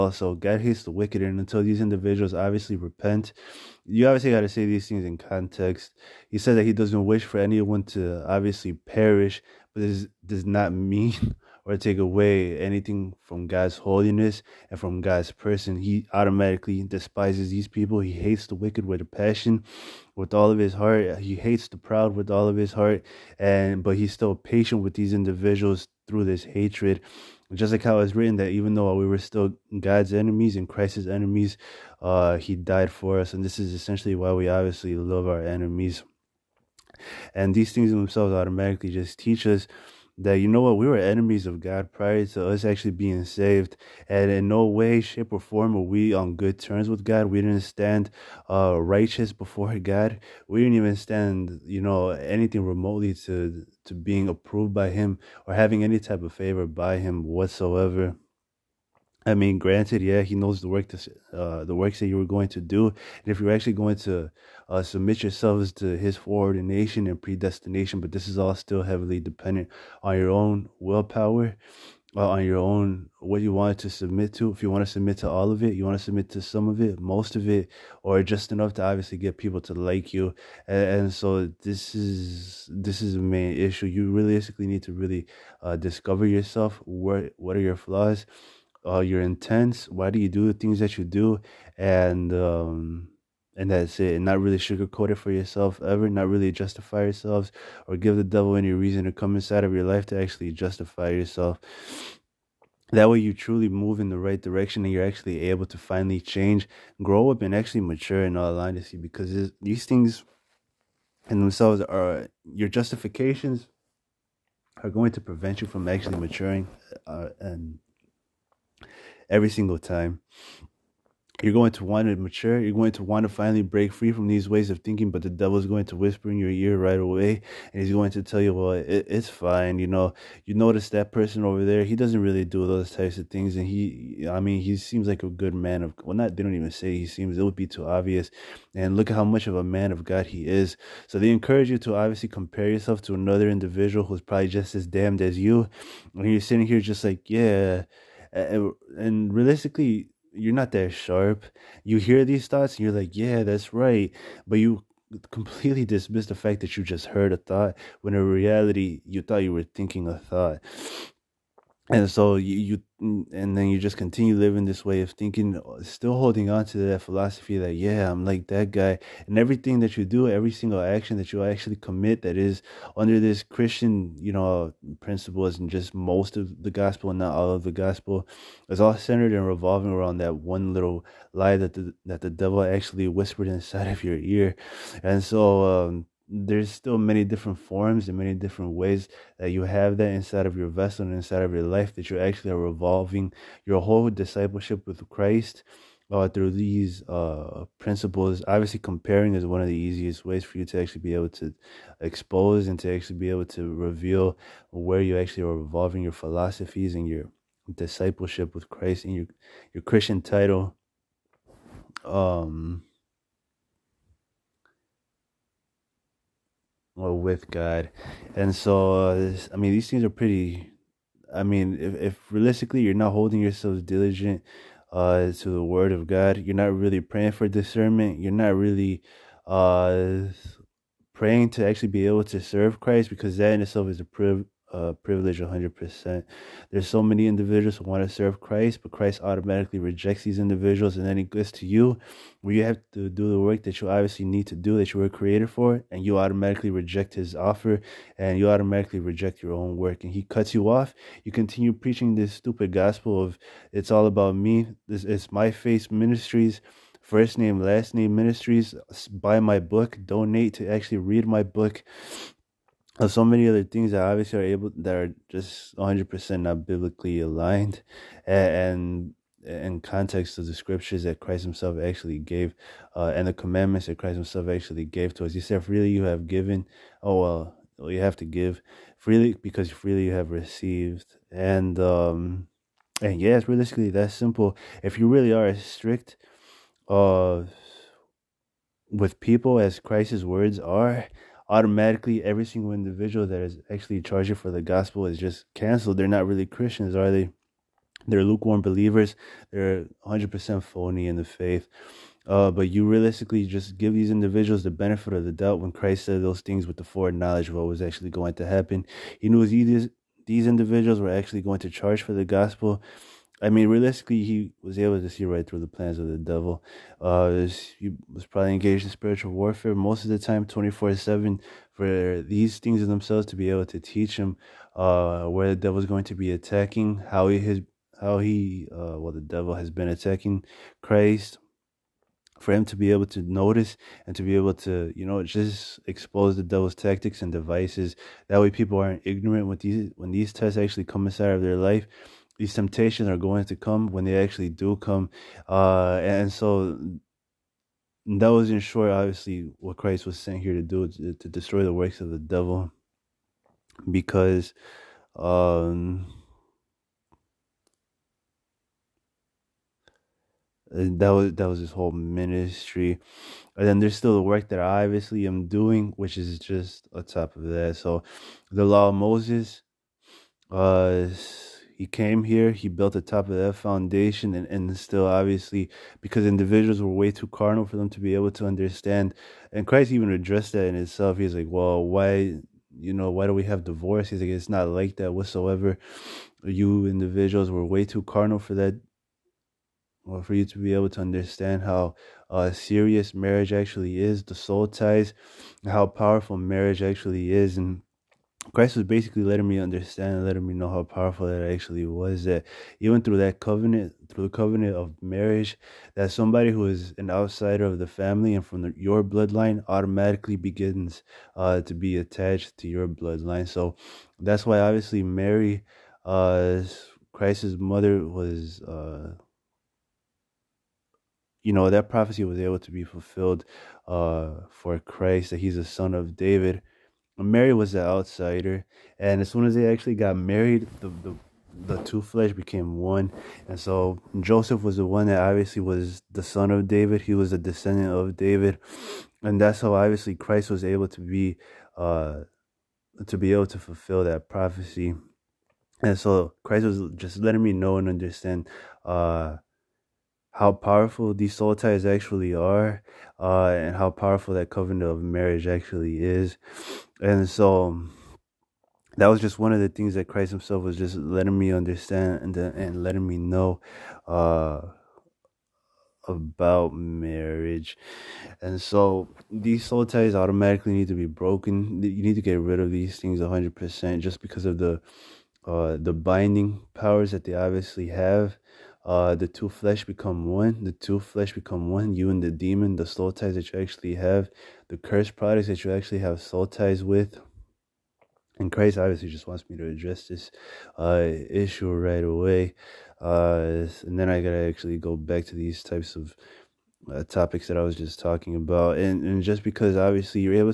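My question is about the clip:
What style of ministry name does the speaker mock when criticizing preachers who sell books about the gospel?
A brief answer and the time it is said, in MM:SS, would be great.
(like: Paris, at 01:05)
First name last name ministries, at 04:17.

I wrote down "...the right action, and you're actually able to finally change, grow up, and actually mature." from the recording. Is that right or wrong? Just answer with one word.
wrong.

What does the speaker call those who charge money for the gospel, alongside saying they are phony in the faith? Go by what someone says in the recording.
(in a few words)
Lukewarm believers.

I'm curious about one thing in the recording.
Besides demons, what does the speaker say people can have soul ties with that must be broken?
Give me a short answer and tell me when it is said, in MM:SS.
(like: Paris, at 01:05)
Cursed products, at 08:04.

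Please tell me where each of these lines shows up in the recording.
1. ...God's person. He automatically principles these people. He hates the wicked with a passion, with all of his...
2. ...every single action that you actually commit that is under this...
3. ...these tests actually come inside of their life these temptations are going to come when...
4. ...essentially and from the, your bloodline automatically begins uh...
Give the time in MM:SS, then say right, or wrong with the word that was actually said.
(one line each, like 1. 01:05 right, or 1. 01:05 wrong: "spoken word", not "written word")
1. 00:14 wrong: "despises", not "principles"
2. 02:50 right
3. 05:40 right
4. 06:47 wrong: "family", not "essentially".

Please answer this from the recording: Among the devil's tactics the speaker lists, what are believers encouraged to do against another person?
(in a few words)
Compare.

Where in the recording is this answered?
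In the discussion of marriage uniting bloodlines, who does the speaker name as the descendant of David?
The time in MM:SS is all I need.
07:14.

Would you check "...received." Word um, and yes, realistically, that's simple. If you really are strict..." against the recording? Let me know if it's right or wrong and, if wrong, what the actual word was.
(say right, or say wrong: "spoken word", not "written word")
wrong: "And", not "Word".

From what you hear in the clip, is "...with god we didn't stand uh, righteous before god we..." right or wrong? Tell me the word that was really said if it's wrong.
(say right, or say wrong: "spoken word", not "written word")
right.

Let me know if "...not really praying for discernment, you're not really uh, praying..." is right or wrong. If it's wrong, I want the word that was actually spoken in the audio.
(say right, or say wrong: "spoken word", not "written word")
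right.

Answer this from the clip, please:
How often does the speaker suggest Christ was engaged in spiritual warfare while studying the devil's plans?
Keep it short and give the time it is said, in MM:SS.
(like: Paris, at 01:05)
24/7, at 05:20.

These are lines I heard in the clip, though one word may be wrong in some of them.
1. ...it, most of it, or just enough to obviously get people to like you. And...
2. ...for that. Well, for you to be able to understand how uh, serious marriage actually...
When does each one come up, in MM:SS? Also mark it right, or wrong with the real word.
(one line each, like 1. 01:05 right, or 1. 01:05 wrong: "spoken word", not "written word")
1. 01:16 right
2. 06:28 right.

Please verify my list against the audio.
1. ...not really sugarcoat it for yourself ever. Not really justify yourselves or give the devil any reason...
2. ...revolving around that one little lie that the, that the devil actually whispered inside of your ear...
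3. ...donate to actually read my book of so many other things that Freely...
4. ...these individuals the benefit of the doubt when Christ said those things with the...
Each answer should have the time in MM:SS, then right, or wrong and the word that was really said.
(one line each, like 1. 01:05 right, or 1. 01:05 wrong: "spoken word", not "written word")
1. 01:34 right
2. 02:59 right
3. 04:20 wrong: "obviously", not "Freely"
4. 05:03 right.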